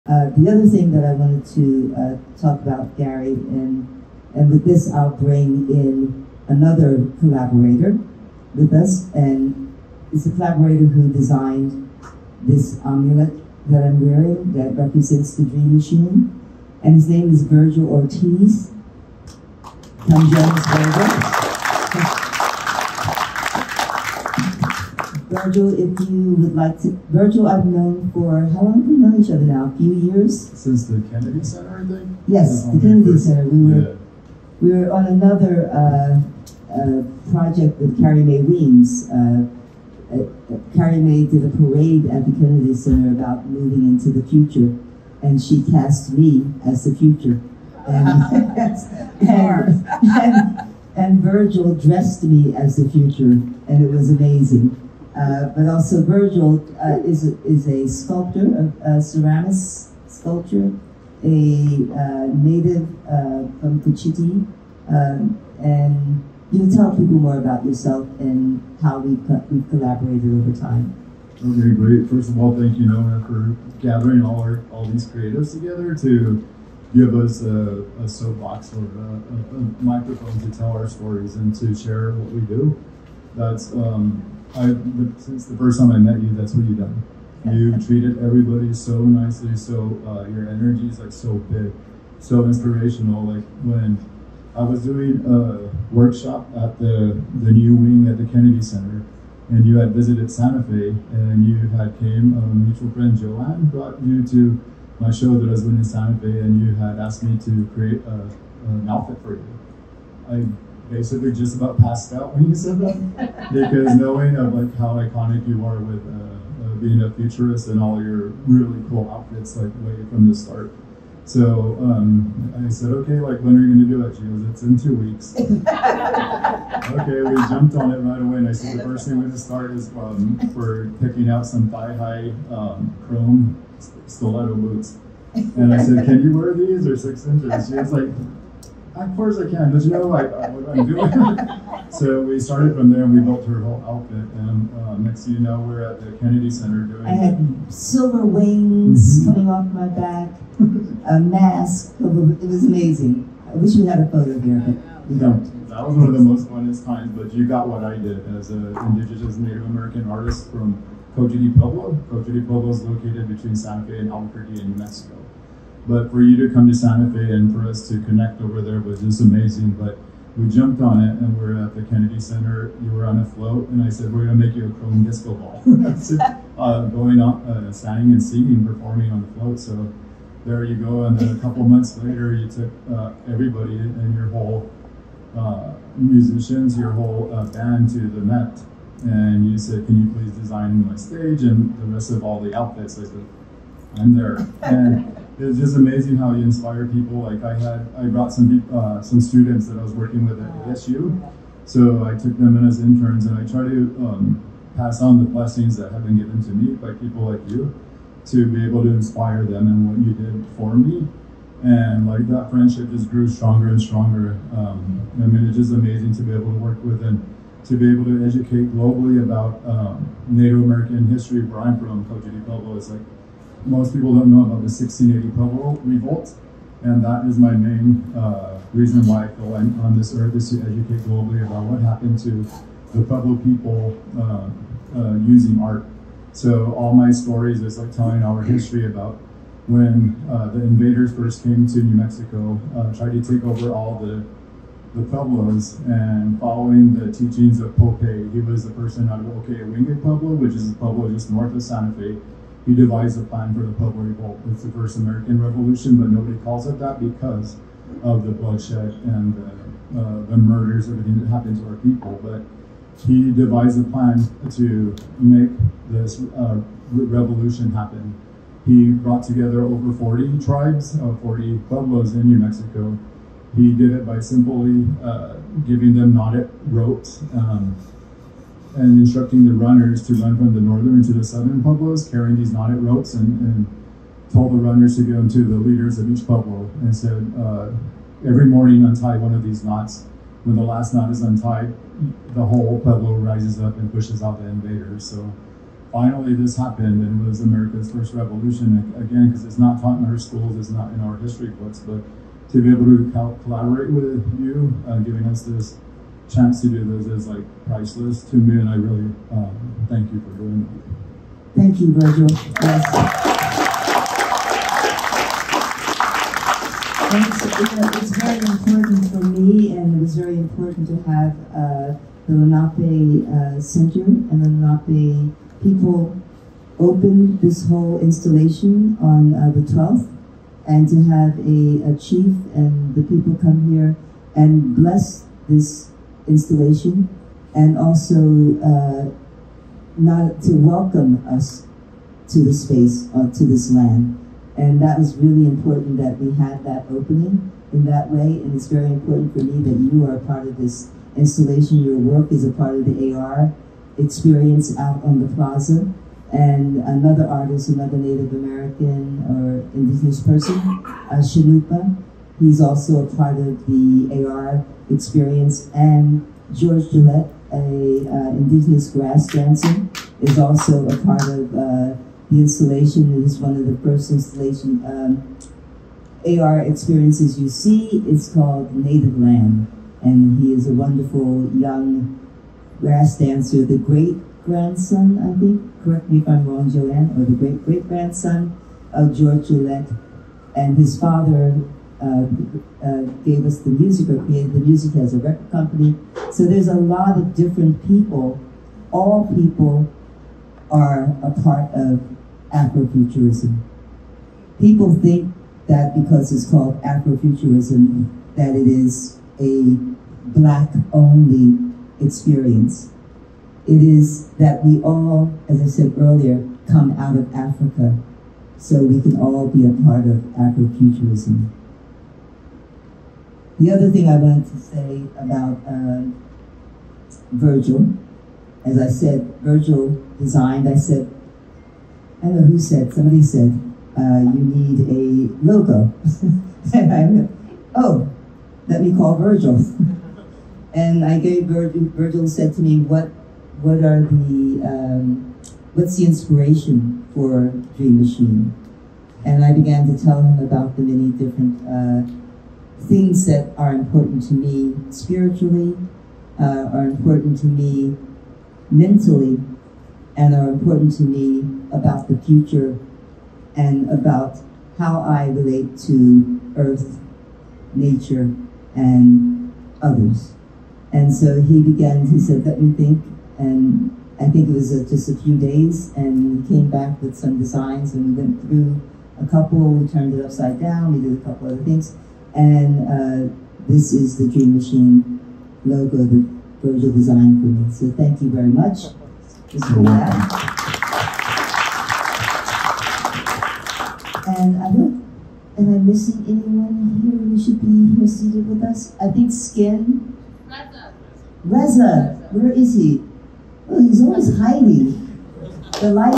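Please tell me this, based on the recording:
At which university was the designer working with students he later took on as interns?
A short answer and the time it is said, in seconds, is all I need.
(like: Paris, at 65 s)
ASU, at 200 s.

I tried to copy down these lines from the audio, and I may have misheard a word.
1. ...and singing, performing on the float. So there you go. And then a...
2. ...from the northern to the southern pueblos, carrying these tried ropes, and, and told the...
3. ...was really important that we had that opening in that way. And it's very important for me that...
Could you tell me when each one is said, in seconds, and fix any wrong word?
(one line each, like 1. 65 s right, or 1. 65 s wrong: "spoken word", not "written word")
1. 177 s right
2. 280 s wrong: "knotted", not "tried"
3. 344 s right.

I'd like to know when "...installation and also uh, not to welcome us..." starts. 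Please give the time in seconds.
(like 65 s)
336 s.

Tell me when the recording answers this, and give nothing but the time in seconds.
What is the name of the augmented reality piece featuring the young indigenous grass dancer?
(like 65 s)
378 s.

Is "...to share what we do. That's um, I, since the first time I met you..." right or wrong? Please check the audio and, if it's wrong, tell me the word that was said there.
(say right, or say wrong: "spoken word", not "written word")
right.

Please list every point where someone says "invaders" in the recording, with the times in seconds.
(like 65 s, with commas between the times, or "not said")
240 s, 294 s.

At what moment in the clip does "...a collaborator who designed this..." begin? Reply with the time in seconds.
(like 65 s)
10 s.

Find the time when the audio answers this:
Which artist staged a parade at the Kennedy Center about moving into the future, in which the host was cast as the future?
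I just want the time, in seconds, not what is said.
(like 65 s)
38 s.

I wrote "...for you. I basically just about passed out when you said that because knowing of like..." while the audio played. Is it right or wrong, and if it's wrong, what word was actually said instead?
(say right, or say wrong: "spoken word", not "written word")
right.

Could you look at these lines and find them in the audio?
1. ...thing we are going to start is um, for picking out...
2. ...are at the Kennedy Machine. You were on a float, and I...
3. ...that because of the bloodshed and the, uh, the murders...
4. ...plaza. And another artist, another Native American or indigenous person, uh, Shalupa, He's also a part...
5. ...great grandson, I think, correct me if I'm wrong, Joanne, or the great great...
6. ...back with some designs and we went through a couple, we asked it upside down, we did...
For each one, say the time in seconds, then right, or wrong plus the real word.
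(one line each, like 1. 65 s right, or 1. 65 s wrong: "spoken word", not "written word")
1. 129 s right
2. 171 s wrong: "Center", not "Machine"
3. 256 s right
4. 355 s right
5. 383 s right
6. 476 s wrong: "turned", not "asked".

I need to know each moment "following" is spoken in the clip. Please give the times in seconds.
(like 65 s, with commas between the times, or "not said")
246 s.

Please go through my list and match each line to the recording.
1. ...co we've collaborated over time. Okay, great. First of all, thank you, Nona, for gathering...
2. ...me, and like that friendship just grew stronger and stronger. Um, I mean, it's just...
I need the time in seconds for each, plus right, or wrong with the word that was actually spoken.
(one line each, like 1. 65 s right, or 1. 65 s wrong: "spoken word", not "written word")
1. 69 s right
2. 210 s right.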